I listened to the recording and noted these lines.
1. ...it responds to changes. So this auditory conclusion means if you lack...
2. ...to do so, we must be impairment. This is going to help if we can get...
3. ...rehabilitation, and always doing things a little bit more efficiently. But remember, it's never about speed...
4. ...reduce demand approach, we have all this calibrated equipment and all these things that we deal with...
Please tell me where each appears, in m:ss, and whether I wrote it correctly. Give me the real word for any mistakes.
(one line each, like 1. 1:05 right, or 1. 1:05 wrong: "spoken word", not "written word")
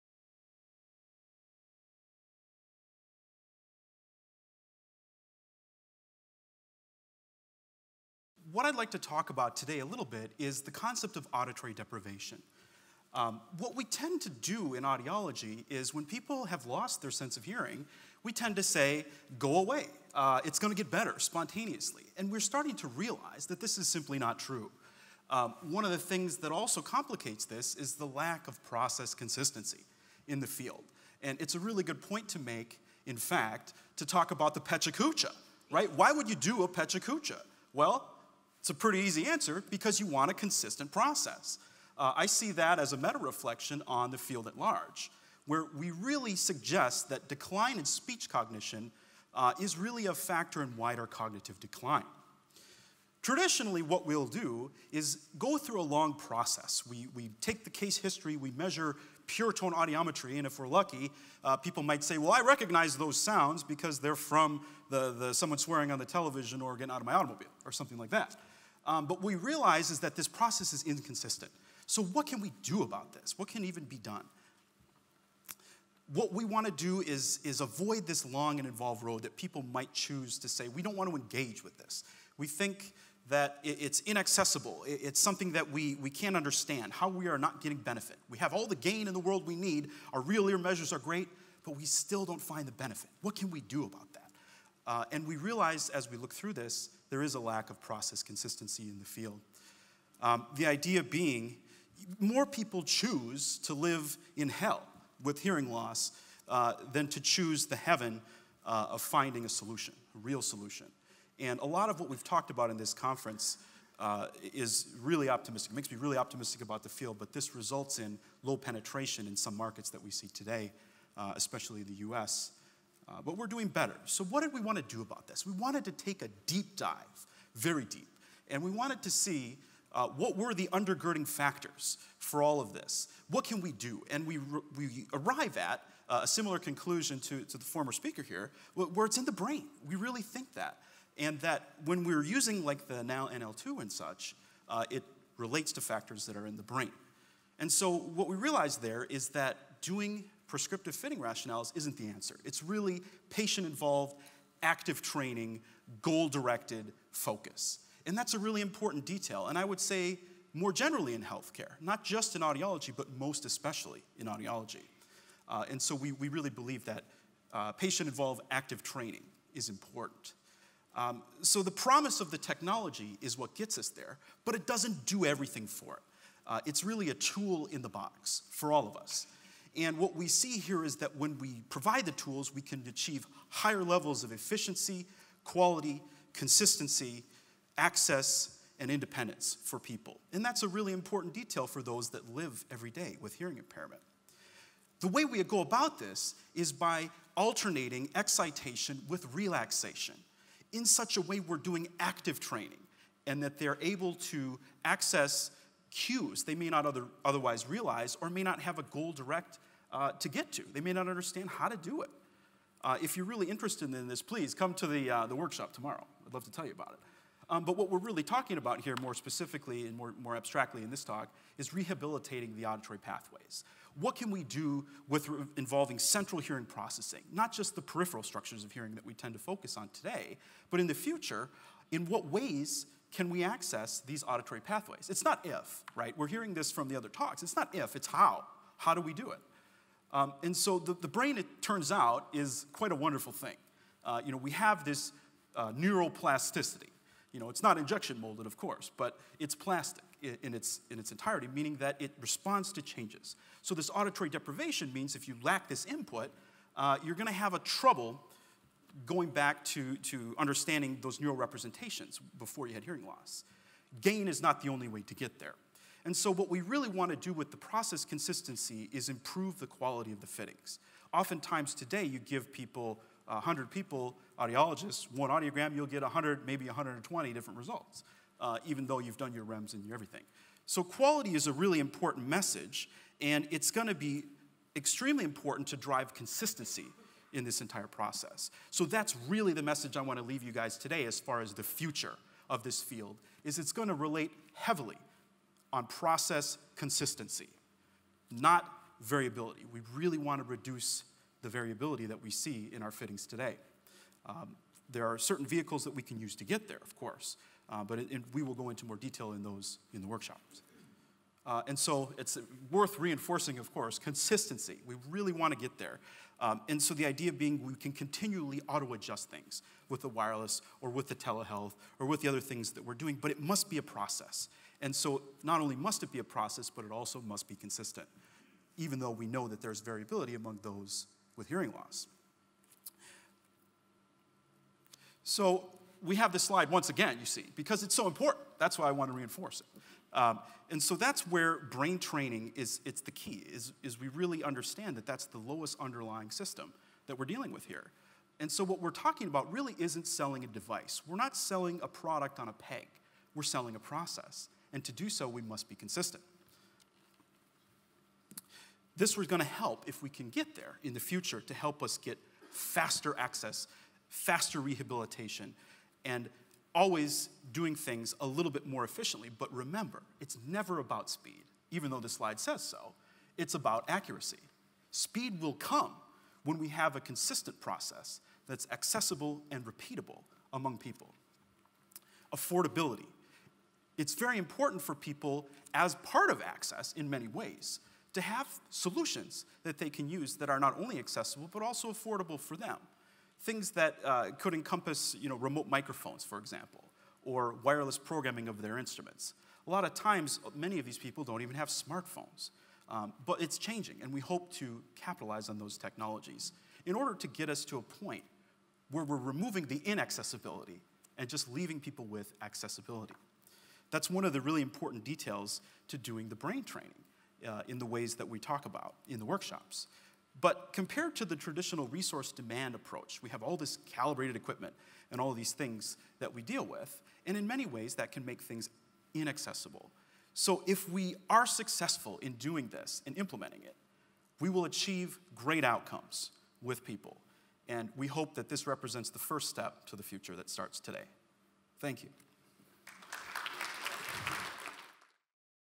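1. 4:11 wrong: "deprivation", not "conclusion"
2. 5:54 wrong: "consistent", not "impairment"
3. 6:04 right
4. 7:01 wrong: "resource", not "reduce".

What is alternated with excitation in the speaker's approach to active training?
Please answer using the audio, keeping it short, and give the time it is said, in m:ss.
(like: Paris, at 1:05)
relaxation, at 3:19.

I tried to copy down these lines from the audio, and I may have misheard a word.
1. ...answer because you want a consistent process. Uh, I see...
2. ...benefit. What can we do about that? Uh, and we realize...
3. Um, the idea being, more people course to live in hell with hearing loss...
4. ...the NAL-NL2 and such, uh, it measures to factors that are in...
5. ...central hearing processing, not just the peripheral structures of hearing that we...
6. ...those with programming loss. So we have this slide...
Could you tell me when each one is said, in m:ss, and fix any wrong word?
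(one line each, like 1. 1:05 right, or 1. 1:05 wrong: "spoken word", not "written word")
1. 0:39 right
2. 1:32 right
3. 1:40 wrong: "choose", not "course"
4. 2:22 wrong: "relates", not "measures"
5. 3:45 right
6. 5:30 wrong: "hearing", not "programming".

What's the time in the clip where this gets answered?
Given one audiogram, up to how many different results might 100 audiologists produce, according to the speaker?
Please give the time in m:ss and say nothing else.
4:36.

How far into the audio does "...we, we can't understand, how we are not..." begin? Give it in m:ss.
1:25.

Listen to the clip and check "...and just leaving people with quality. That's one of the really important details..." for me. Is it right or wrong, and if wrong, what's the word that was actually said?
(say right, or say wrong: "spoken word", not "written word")
wrong: "accessibility", not "quality".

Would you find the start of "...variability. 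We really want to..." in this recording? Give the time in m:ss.
4:59.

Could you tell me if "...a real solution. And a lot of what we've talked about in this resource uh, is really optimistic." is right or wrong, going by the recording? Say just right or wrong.
wrong.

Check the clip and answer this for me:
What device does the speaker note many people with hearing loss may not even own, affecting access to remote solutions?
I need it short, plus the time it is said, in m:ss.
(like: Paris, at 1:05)
smartphones, at 6:41.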